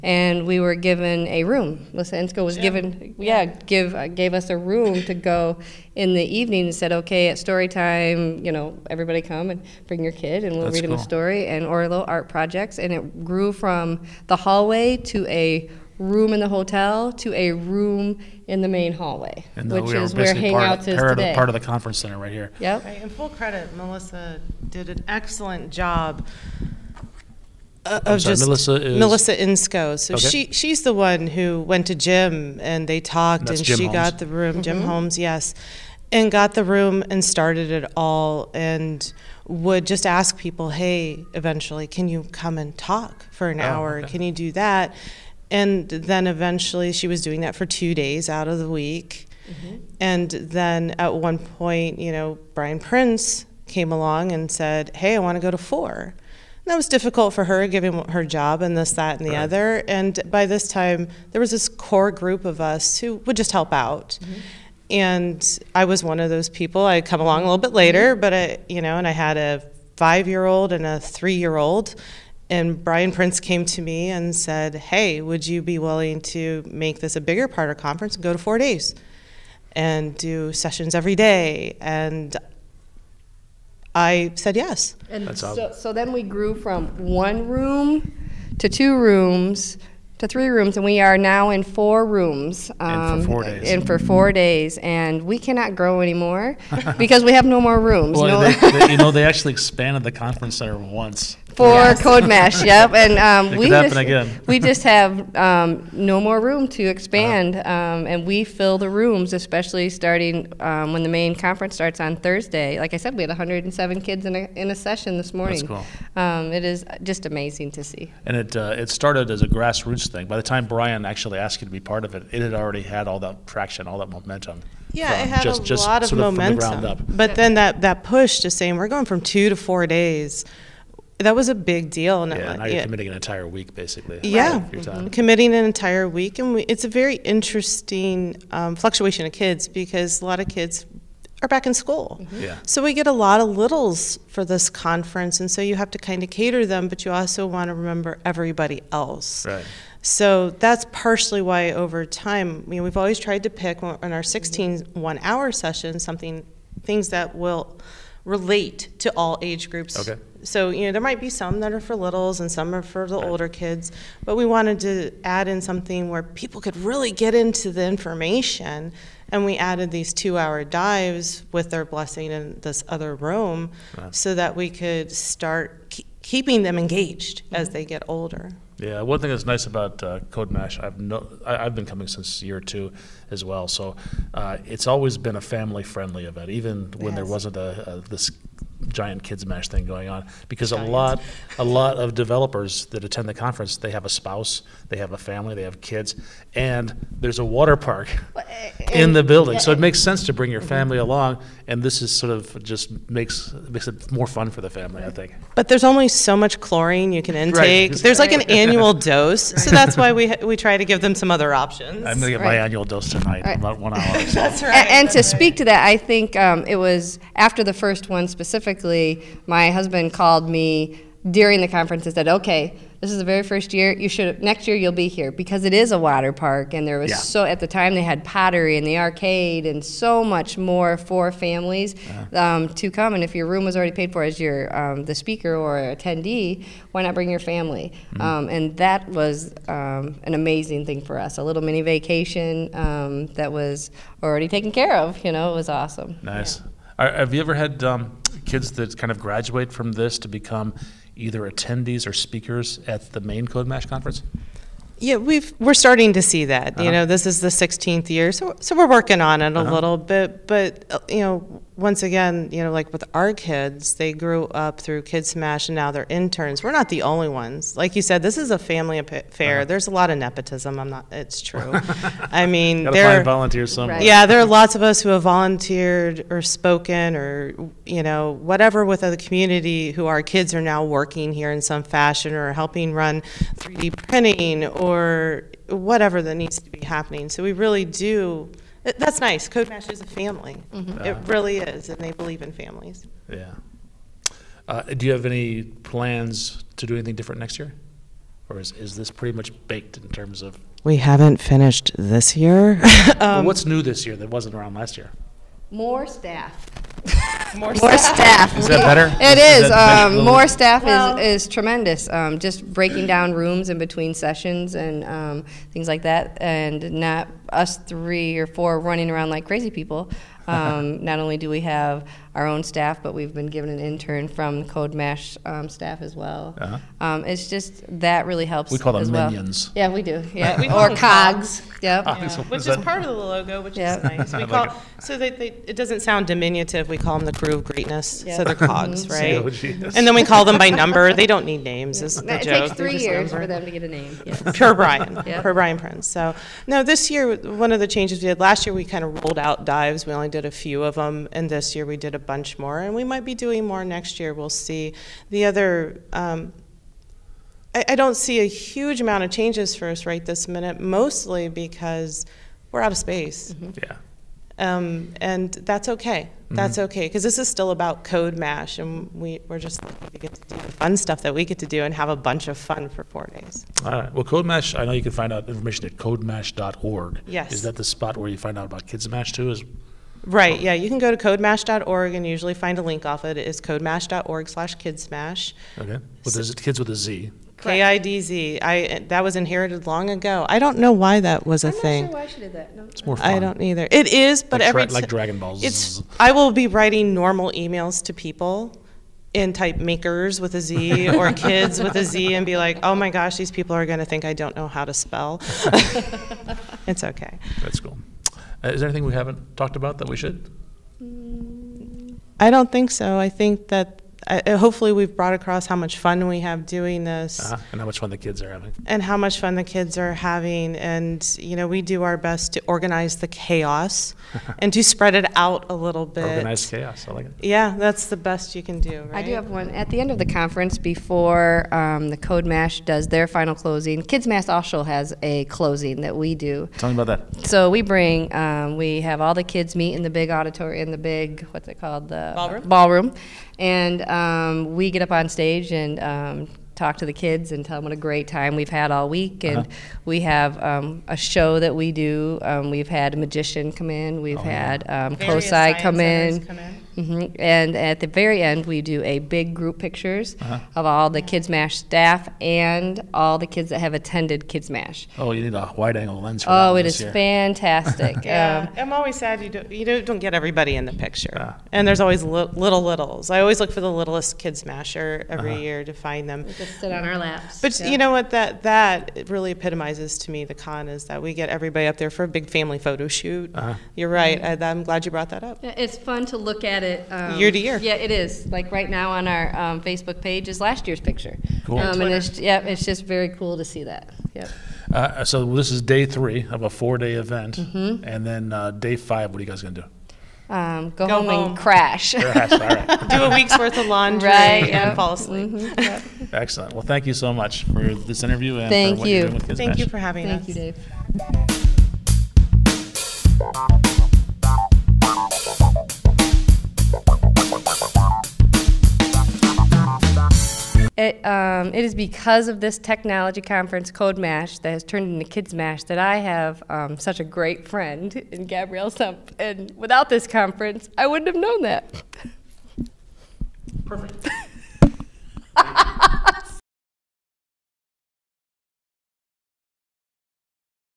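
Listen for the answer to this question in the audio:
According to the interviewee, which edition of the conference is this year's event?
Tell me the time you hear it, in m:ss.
4:17.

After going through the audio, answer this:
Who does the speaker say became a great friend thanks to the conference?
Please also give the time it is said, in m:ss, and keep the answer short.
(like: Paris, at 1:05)
Gabrielle Sempf, at 8:48.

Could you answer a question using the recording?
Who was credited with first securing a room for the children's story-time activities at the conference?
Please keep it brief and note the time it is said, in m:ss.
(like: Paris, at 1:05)
Melissa Insko, at 0:28.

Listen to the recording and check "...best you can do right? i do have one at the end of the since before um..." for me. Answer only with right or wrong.
wrong.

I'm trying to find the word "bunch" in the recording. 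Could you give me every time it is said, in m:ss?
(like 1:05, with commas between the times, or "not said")
5:52, 6:12.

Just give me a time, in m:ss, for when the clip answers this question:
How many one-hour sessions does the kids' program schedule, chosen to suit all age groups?
2:34.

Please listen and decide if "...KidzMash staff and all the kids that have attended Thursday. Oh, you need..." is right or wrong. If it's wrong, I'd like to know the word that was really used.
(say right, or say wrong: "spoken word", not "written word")
wrong: "KidzMash", not "Thursday".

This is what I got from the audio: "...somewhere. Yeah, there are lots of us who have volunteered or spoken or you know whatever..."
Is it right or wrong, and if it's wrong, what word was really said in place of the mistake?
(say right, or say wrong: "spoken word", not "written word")
right.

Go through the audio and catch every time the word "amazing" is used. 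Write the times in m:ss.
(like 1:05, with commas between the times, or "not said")
1:57, 4:00.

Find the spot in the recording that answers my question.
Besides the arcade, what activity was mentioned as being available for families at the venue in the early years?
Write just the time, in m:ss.
3:48.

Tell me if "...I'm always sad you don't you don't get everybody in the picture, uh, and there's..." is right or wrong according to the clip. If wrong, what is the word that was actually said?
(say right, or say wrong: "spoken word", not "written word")
right.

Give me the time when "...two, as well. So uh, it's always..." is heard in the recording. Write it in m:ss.
3:02.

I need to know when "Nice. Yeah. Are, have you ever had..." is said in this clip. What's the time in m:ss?
4:06.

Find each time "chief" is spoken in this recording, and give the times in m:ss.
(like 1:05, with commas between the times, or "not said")
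not said.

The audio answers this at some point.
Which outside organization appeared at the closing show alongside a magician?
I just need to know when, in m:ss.
7:35.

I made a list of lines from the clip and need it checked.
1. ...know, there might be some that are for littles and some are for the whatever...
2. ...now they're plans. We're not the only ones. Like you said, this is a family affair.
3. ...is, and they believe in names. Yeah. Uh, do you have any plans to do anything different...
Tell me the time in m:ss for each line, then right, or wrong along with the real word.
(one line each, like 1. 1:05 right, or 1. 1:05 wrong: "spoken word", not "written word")
1. 2:40 wrong: "older", not "whatever"
2. 4:25 wrong: "interns", not "plans"
3. 4:51 wrong: "families", not "names".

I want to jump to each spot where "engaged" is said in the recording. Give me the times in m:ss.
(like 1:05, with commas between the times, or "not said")
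2:56.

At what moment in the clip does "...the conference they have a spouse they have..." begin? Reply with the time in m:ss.
3:13.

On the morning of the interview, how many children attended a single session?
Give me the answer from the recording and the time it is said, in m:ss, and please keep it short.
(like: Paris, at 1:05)
107, at 1:53.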